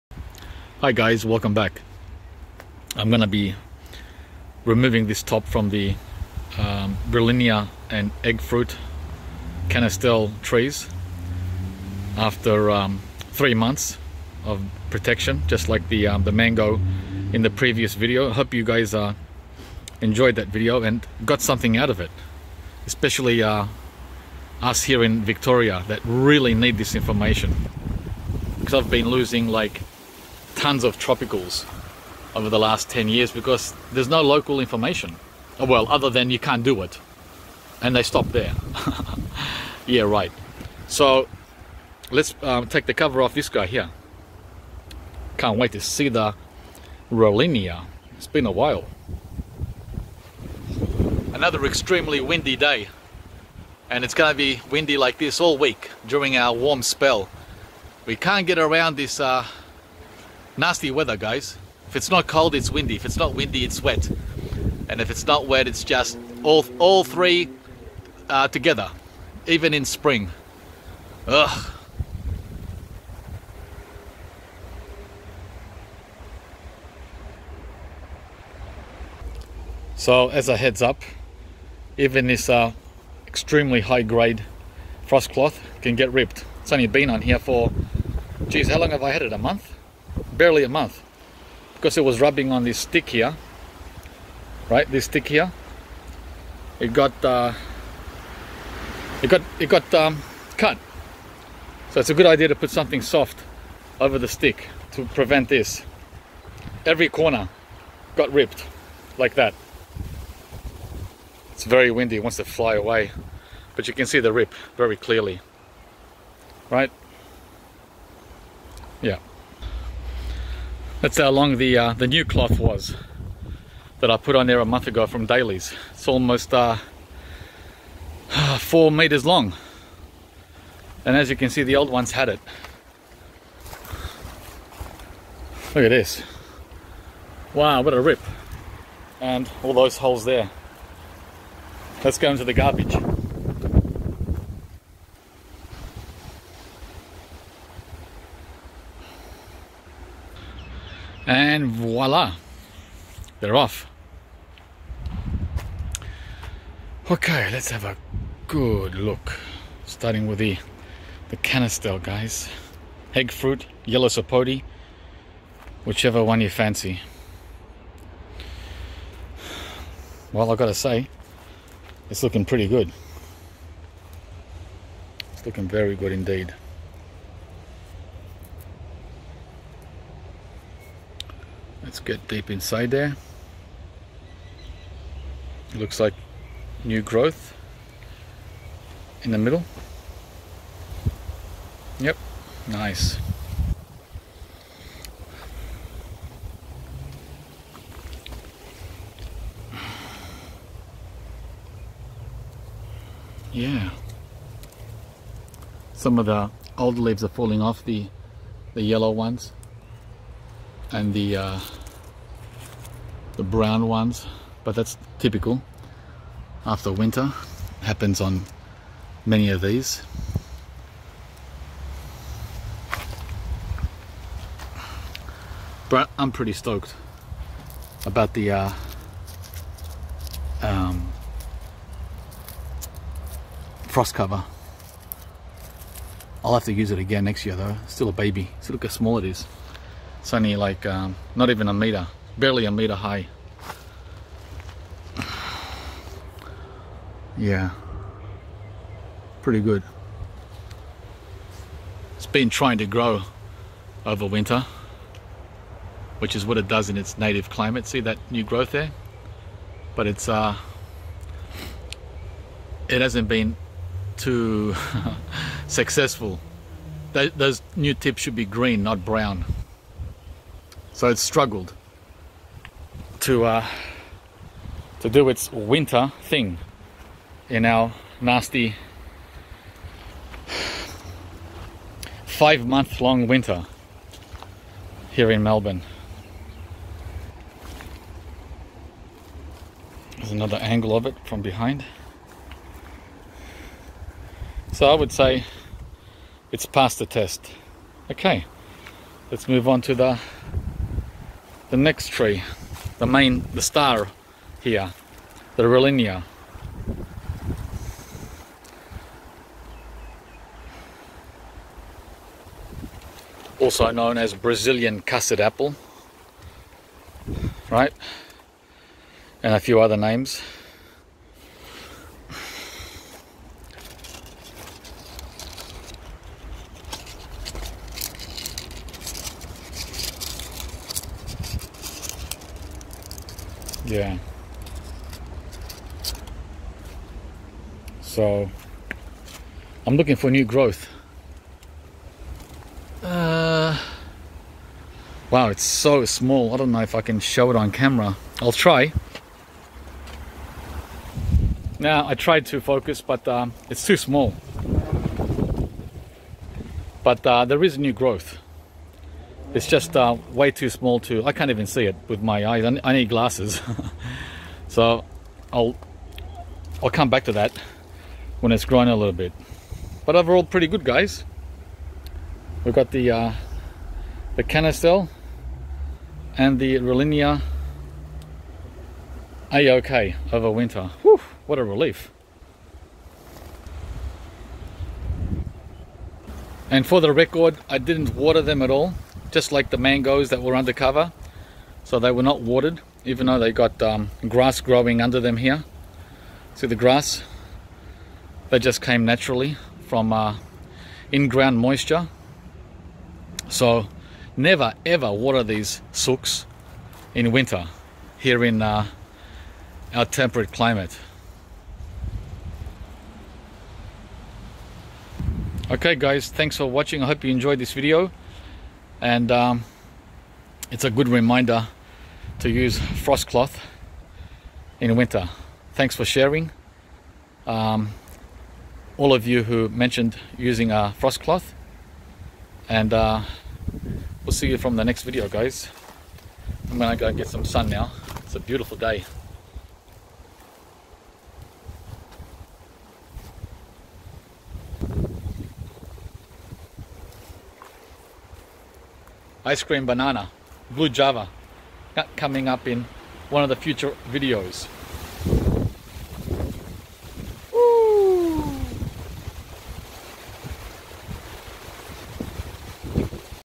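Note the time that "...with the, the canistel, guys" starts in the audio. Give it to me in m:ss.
2:40.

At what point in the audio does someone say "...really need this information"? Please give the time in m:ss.
0:26.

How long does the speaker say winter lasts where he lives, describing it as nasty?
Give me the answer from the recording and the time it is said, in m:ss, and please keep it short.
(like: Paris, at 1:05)
5 months, at 4:42.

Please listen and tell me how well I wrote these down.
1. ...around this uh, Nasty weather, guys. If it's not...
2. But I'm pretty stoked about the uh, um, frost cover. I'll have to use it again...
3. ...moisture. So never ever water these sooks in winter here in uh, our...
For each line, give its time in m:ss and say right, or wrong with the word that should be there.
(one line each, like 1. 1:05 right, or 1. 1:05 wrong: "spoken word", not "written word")
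1. 0:58 right
2. 3:45 right
3. 6:41 right.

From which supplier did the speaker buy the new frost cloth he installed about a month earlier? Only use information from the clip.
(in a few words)
Daleys.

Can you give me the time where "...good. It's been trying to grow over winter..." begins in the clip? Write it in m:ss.
4:09.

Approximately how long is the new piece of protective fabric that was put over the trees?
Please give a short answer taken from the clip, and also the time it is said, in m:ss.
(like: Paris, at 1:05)
4 meters, at 2:08.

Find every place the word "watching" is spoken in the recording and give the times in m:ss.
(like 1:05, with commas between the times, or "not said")
6:56.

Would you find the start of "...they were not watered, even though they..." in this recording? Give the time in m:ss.
6:31.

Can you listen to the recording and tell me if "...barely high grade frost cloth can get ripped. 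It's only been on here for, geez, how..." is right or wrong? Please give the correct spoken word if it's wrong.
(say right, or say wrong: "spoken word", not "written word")
wrong: "extremely", not "barely".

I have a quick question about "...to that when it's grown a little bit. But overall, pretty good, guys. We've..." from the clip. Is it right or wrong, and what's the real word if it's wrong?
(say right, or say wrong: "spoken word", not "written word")
right.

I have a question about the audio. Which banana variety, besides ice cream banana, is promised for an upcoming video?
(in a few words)
Blue Java.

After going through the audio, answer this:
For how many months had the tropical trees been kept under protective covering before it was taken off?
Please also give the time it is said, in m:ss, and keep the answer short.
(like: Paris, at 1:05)
3, at 0:13.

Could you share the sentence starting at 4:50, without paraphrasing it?
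There's another angle of it from behind.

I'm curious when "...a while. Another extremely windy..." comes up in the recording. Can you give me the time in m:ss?
0:48.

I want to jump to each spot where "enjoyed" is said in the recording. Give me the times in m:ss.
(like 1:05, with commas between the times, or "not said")
0:20, 6:57.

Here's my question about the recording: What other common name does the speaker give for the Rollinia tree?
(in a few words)
Brazilian custard apple.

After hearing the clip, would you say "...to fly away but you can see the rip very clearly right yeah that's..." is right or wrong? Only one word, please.
right.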